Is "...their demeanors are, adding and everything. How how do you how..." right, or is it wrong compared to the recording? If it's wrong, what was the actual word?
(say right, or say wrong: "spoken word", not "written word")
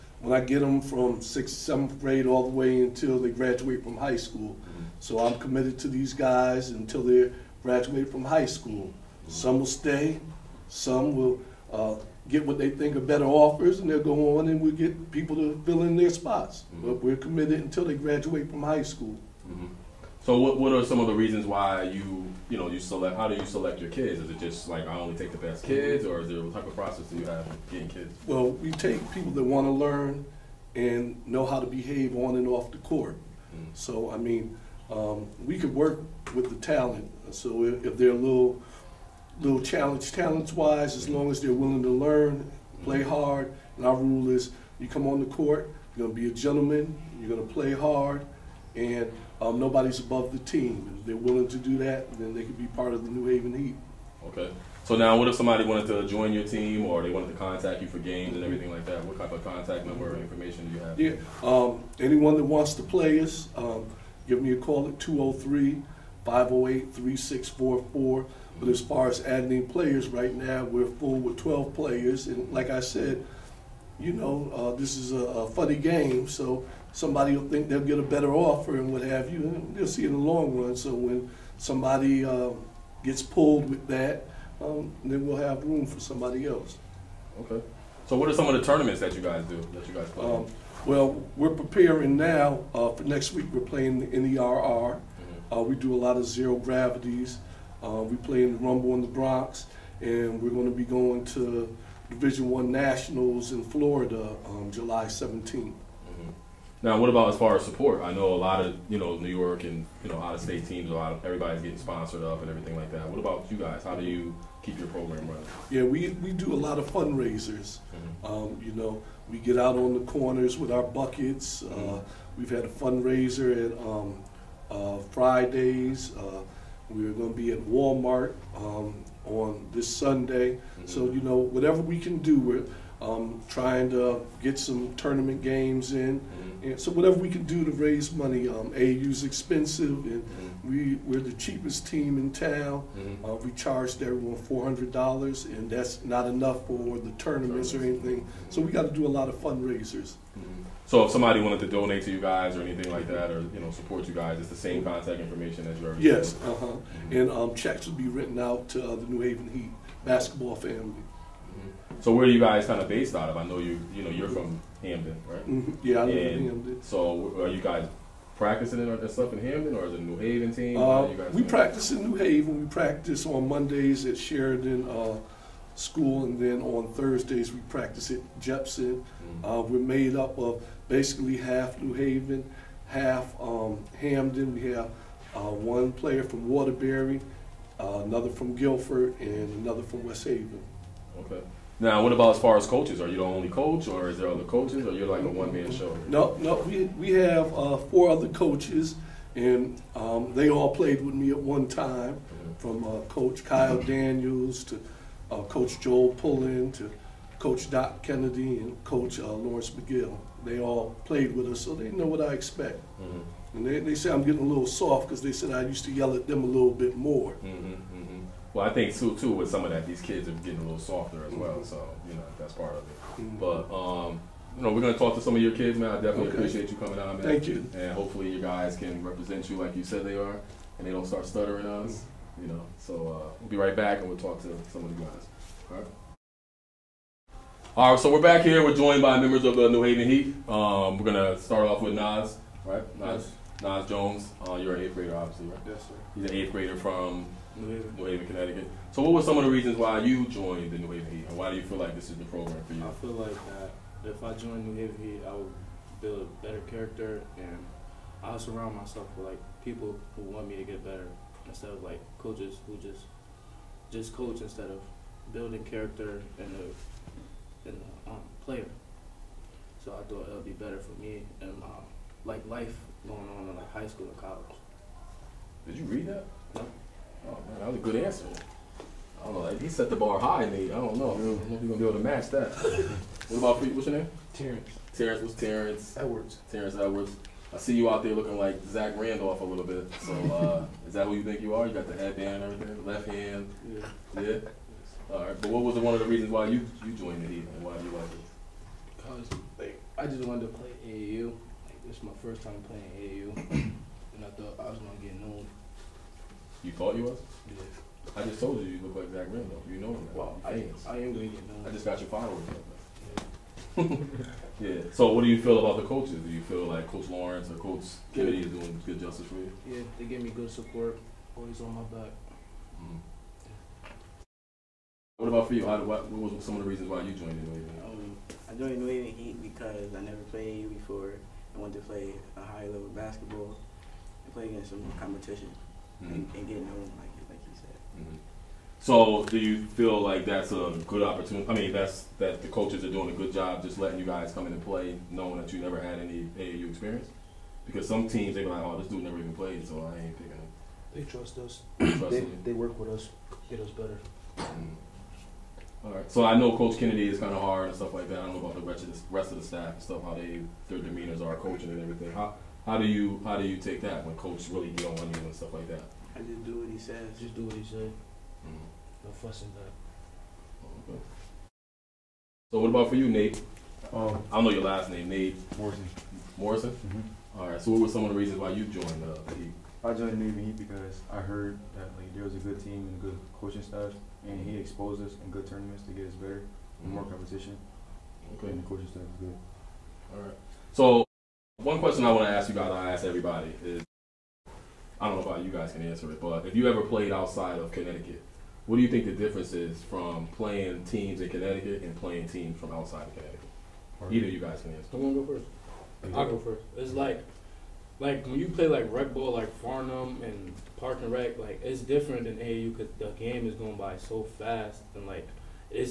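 wrong: "coaching", not "adding".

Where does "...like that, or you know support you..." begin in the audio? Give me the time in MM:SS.
02:32.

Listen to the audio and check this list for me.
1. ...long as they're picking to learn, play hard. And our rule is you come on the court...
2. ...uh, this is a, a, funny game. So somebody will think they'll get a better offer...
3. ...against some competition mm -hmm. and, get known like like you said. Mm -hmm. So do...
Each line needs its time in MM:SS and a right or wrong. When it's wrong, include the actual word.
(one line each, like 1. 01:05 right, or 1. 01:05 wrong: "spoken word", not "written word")
1. 00:41 wrong: "willing", not "picking"
2. 01:14 right
3. 05:34 right.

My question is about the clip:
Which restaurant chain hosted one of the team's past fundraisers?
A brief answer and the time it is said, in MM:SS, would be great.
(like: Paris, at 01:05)
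Fridays, at 02:05.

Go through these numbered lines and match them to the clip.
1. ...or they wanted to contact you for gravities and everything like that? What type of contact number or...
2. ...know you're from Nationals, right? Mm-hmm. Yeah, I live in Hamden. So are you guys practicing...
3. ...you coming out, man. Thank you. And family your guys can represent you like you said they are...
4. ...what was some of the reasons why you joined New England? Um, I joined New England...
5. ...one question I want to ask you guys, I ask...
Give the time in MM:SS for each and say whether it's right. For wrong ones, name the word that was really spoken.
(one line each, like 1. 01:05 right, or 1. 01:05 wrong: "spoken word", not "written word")
1. 00:56 wrong: "games", not "gravities"
2. 02:44 wrong: "Hamden", not "Nationals"
3. 03:46 wrong: "hopefully", not "family"
4. 05:26 right
5. 06:31 right.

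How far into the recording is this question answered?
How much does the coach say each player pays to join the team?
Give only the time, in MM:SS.
02:24.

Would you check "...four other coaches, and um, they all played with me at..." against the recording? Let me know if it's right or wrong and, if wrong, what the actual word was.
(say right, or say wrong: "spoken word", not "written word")
right.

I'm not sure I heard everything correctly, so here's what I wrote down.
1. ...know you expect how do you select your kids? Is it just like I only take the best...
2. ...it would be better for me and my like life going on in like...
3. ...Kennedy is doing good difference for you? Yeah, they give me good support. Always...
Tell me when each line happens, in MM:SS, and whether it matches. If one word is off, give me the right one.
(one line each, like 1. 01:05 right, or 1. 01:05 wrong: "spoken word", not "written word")
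1. 00:22 wrong: "select", not "expect"
2. 04:30 right
3. 05:18 wrong: "justice", not "difference".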